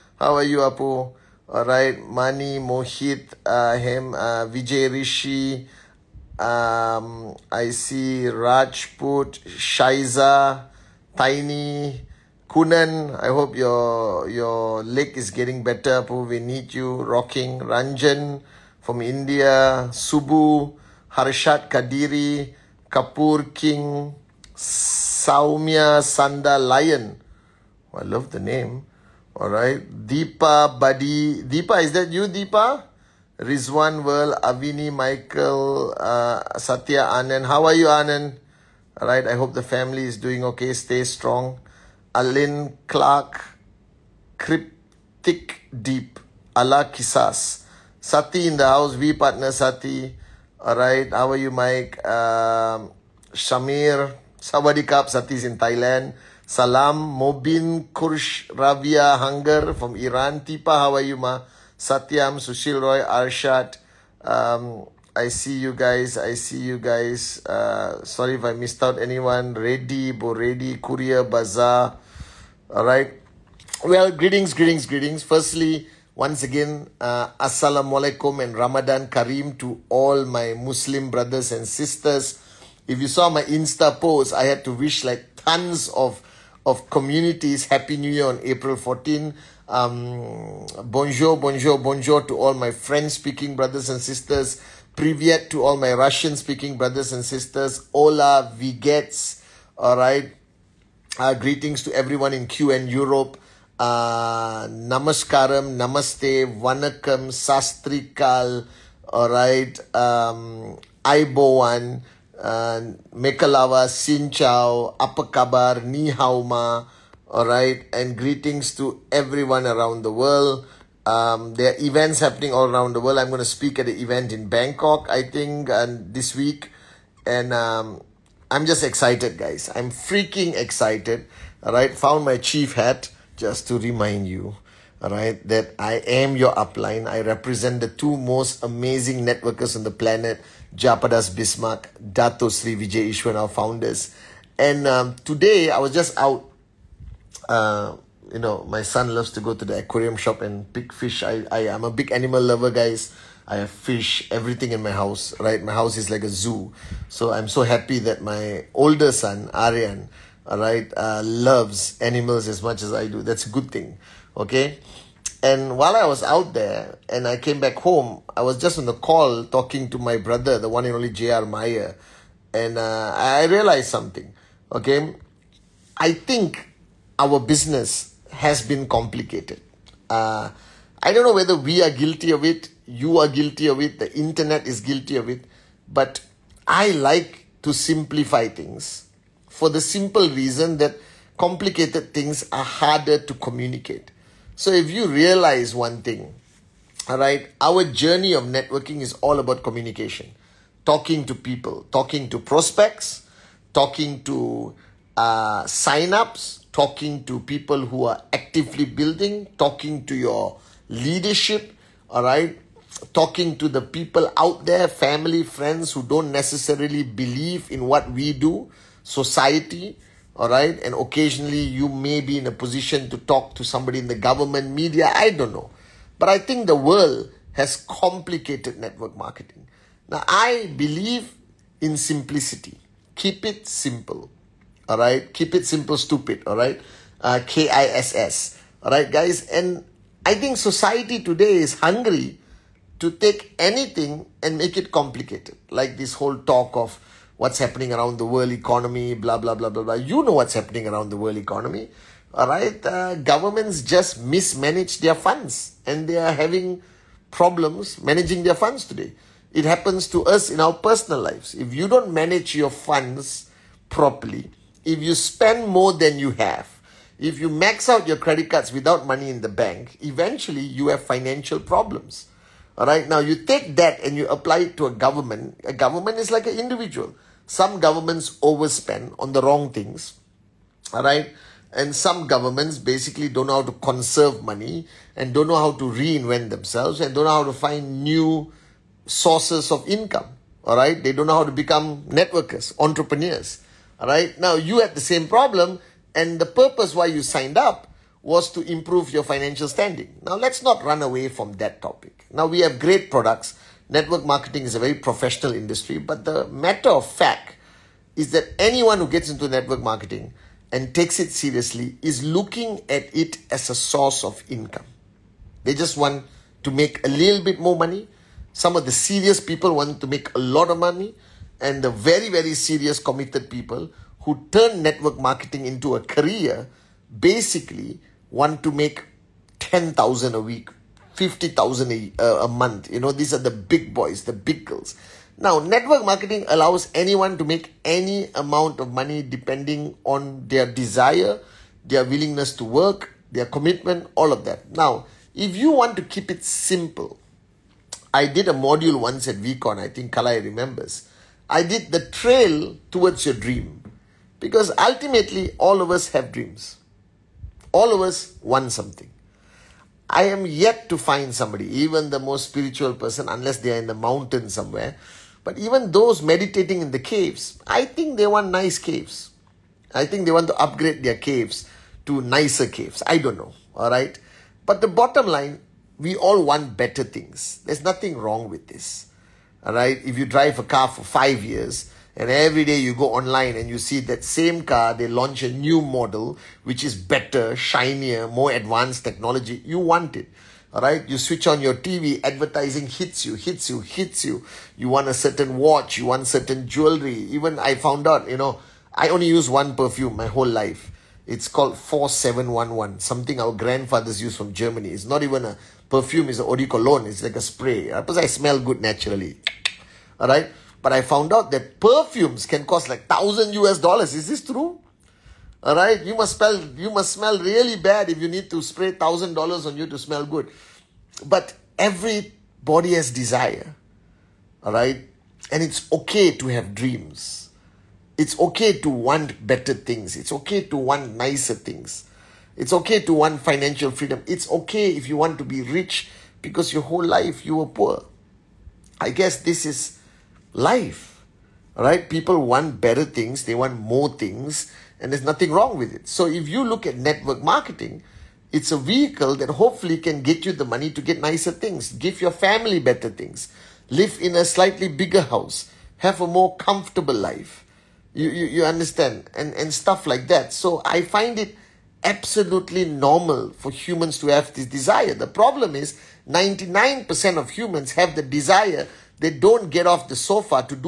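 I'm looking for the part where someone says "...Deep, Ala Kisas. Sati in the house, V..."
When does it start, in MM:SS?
00:45.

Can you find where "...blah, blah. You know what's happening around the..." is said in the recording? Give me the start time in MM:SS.
04:09.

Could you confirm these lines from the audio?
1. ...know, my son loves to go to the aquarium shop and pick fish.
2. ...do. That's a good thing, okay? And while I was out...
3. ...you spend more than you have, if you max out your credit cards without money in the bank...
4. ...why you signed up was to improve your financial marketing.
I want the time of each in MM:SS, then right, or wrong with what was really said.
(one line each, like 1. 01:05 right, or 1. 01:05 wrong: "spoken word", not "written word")
1. 02:28 right
2. 02:43 right
3. 04:25 right
4. 04:56 wrong: "standing", not "marketing".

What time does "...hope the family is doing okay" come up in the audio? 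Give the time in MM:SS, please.
00:39.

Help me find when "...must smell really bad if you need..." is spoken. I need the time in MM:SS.
06:56.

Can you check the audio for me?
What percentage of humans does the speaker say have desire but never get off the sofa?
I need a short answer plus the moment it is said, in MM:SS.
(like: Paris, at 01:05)
99%, at 07:46.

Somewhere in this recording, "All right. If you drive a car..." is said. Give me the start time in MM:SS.
06:19.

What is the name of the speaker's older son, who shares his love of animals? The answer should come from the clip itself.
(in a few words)
Aryan.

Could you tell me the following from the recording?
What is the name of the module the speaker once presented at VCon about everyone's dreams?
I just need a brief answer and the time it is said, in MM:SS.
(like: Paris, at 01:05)
The trail towards your dream, at 05:51.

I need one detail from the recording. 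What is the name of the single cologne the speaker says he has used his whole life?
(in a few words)
4711.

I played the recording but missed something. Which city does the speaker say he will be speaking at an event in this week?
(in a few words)
Bangkok.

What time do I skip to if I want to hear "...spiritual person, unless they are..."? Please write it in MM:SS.
06:02.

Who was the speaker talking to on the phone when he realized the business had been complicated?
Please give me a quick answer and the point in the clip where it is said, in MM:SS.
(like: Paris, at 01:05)
Jr. Meyer, at 02:51.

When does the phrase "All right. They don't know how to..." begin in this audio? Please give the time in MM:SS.
04:50.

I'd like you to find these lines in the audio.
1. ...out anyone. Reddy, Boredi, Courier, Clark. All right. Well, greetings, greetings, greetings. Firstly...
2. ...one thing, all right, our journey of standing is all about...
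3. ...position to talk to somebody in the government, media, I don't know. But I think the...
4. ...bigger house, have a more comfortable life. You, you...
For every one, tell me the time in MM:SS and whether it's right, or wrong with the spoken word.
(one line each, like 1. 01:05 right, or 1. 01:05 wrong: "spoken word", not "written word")
1. 01:08 wrong: "Bazaar", not "Clark"
2. 03:15 wrong: "networking", not "standing"
3. 03:42 right
4. 07:34 right.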